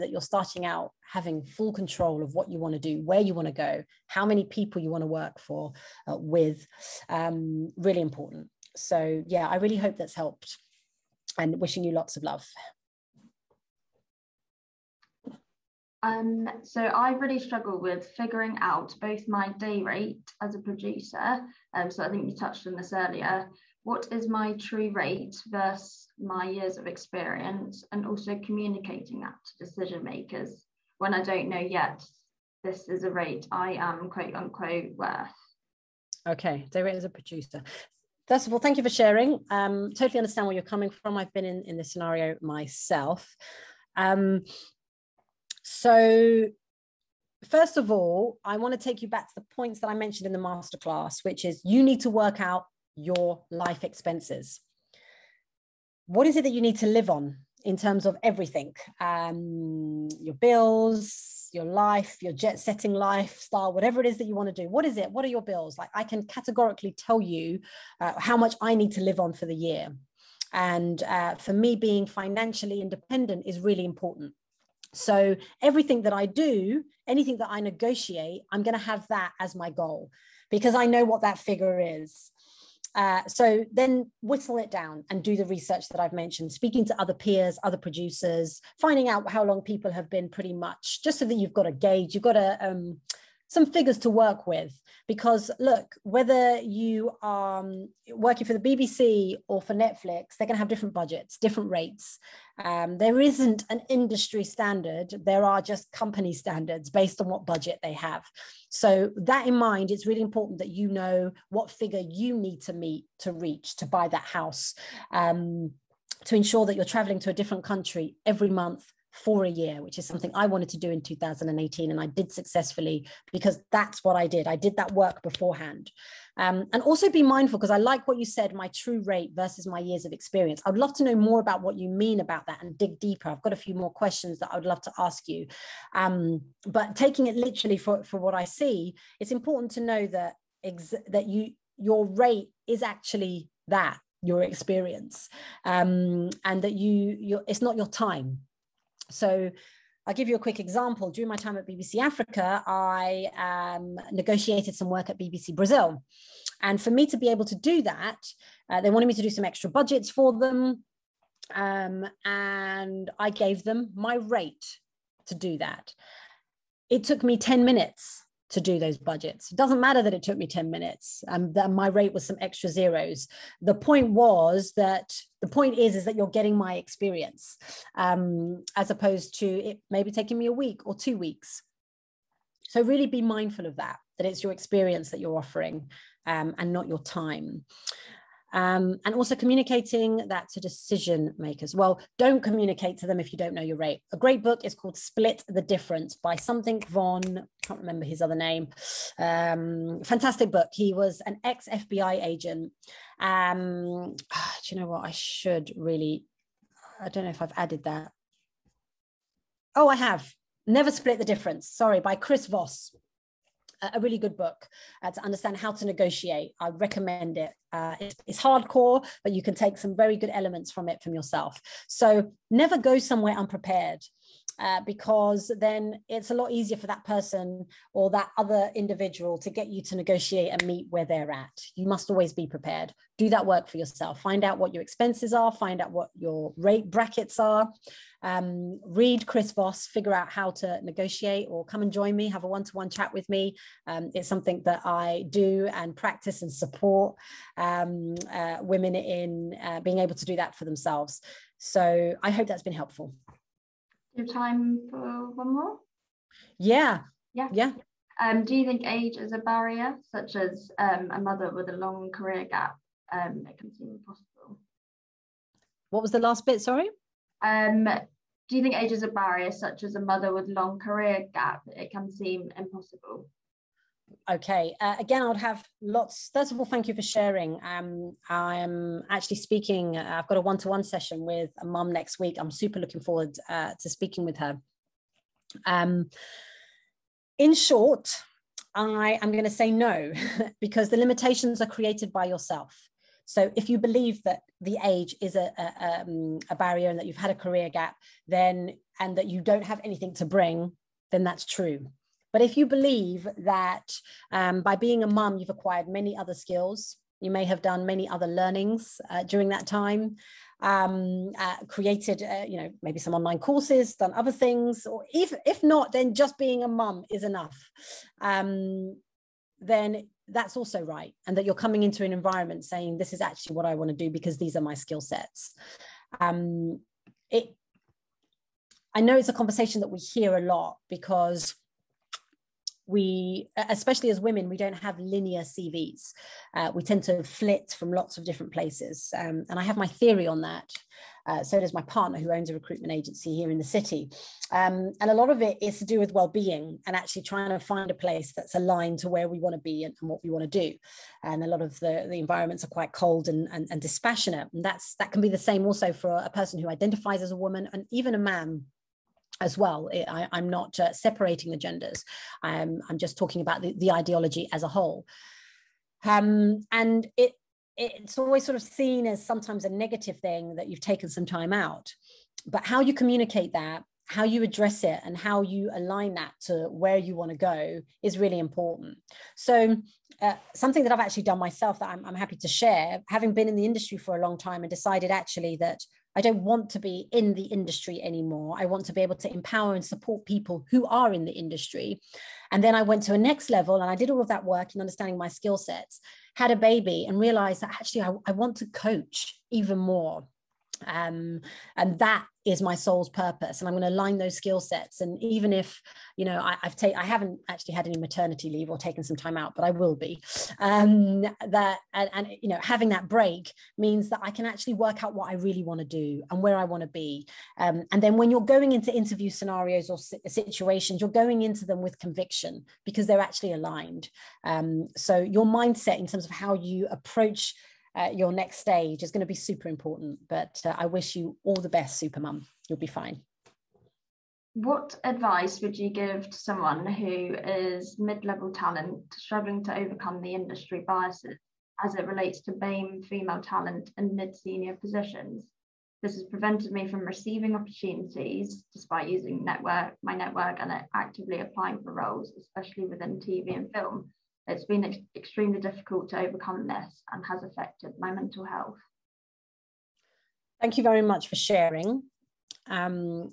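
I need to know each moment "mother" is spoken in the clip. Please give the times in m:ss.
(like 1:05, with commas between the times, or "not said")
4:21, 4:29.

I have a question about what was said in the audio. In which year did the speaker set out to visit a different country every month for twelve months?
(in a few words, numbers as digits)
2018.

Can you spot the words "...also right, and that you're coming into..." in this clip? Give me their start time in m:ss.
5:20.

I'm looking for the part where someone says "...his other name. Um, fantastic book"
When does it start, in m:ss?
3:18.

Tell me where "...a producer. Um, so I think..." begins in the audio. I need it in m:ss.
0:20.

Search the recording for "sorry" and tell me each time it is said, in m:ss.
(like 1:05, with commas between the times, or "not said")
3:31, 4:26.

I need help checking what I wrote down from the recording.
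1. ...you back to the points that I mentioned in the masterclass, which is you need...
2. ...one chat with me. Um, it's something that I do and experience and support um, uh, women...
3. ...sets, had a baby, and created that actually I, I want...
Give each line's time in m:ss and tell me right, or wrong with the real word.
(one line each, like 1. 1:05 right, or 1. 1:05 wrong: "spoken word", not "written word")
1. 0:49 right
2. 4:02 wrong: "practice", not "experience"
3. 6:35 wrong: "realized", not "created".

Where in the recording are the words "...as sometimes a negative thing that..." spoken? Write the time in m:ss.
6:09.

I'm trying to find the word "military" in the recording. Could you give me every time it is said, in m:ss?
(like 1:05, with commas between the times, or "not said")
not said.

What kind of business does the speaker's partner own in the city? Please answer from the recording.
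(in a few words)
recruitment agency.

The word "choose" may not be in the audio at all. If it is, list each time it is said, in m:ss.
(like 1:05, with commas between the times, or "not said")
not said.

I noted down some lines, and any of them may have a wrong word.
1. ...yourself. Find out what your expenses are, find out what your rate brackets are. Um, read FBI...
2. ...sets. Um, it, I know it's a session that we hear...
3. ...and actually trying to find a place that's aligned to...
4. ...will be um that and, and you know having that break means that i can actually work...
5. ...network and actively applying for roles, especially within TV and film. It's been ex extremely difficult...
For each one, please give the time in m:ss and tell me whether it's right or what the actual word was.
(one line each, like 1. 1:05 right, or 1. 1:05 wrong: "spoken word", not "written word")
1. 3:53 wrong: "Chris", not "FBI"
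2. 5:24 wrong: "conversation", not "session"
3. 5:46 right
4. 6:49 right
5. 7:30 right.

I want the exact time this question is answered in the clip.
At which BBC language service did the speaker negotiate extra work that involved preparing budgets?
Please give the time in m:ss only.
2:35.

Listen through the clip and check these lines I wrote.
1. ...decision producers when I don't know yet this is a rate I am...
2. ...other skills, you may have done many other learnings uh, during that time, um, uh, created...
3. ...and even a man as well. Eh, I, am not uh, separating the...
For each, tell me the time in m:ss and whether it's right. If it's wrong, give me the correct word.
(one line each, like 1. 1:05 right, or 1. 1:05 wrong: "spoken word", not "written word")
1. 0:29 wrong: "makers", not "producers"
2. 5:06 right
3. 5:57 right.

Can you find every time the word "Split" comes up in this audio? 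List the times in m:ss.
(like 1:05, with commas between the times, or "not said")
3:14, 3:30.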